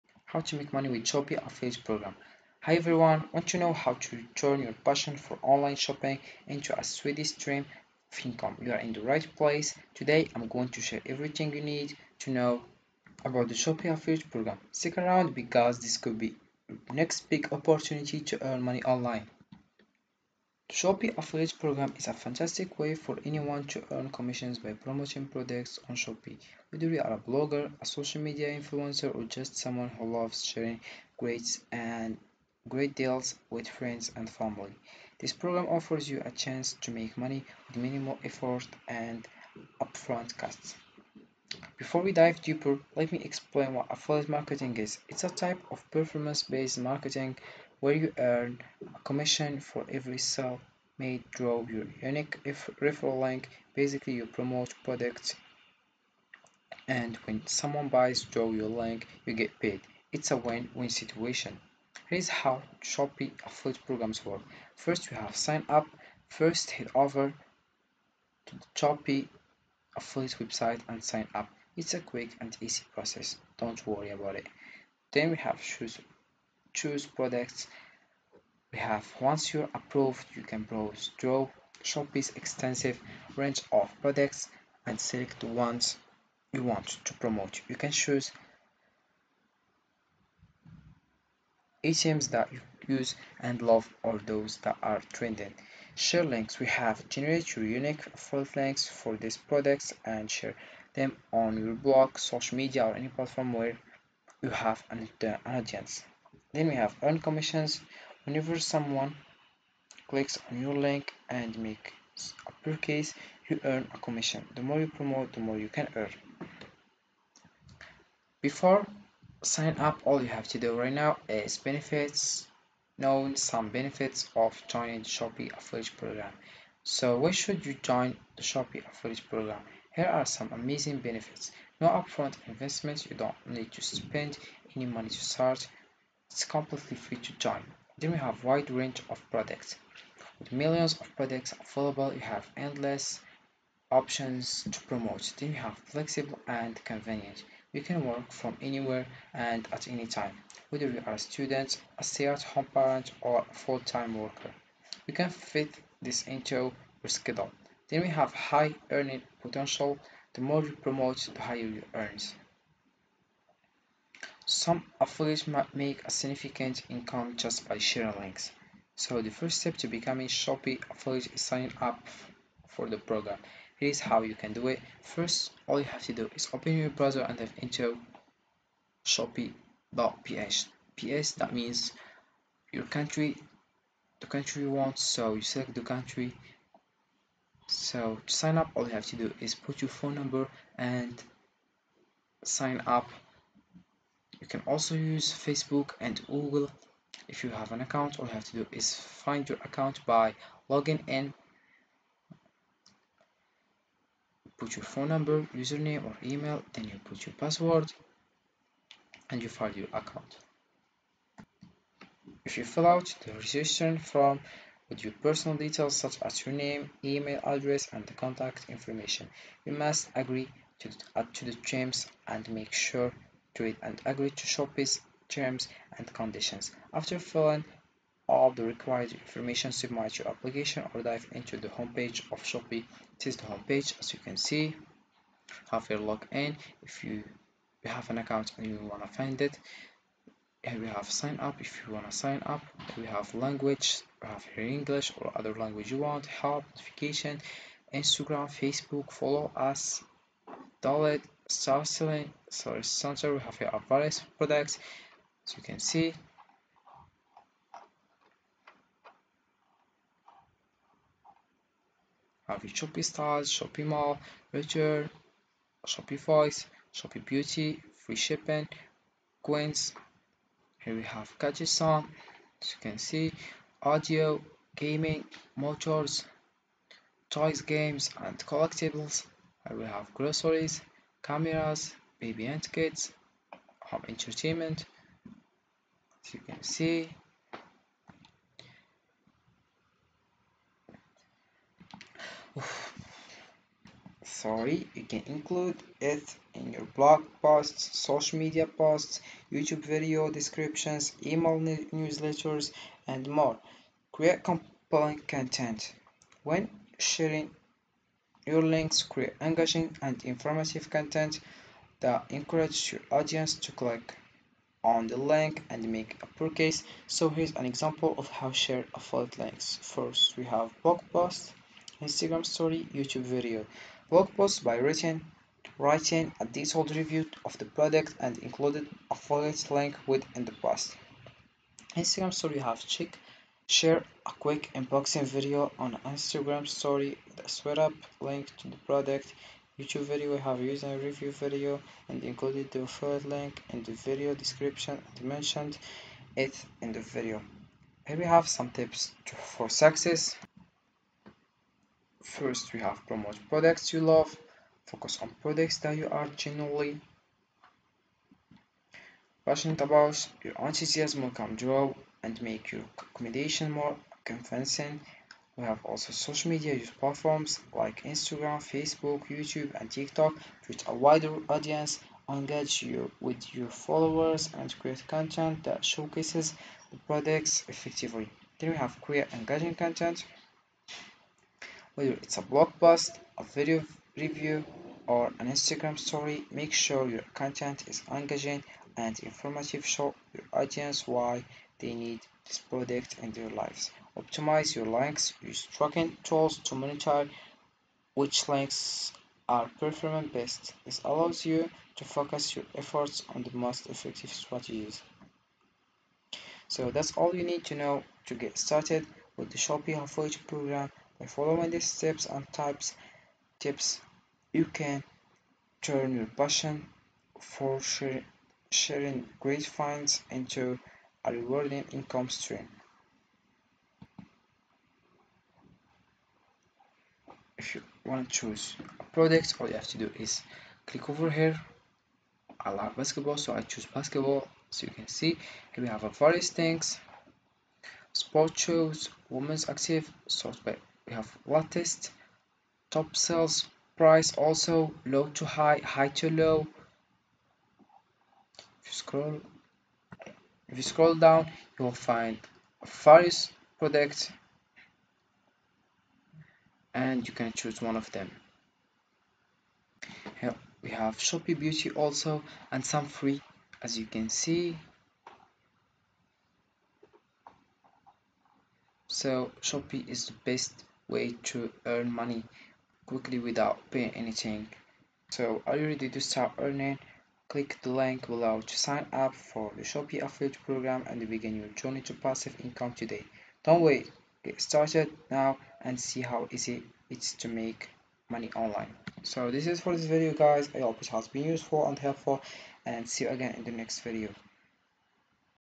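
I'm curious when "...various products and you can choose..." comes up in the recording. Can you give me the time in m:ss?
7:32.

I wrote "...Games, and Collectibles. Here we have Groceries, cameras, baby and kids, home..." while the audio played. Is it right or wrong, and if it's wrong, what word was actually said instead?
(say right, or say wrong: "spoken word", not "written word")
right.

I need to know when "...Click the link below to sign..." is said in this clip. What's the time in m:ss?
7:57.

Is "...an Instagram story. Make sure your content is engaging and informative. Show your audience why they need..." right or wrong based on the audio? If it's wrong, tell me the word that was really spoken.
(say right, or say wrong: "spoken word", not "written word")
right.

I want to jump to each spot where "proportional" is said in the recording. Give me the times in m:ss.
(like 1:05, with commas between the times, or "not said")
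not said.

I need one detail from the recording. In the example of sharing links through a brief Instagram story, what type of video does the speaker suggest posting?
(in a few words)
Unboxing video.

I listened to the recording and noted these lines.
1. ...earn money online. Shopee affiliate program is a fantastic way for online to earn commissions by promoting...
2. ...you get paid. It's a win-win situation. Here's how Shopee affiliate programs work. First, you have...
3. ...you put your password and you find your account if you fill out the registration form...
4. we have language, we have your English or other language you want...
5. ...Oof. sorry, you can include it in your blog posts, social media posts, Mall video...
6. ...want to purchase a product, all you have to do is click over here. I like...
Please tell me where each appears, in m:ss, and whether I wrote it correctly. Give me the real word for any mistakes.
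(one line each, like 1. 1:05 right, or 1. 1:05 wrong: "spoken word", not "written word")
1. 0:18 wrong: "anyone", not "online"
2. 0:59 right
3. 3:26 right
4. 4:02 right
5. 4:52 wrong: "YouTube", not "Mall"
6. 7:08 wrong: "choose", not "purchase".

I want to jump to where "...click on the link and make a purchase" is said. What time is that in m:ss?
5:13.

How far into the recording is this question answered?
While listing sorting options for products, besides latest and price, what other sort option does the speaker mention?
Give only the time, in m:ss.
7:22.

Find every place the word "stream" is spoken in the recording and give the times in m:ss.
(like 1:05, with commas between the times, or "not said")
0:07, 7:02.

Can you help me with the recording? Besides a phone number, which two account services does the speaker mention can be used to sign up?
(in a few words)
Facebook and Google.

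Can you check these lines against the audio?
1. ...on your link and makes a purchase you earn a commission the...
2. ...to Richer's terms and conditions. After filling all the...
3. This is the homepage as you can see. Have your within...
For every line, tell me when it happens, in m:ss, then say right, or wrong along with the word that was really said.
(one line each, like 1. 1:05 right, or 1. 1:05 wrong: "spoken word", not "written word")
1. 1:50 right
2. 3:44 wrong: "Shopee", not "Richer"
3. 3:53 wrong: "login", not "within".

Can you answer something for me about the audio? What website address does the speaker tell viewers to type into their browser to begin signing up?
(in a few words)
shopee.ph.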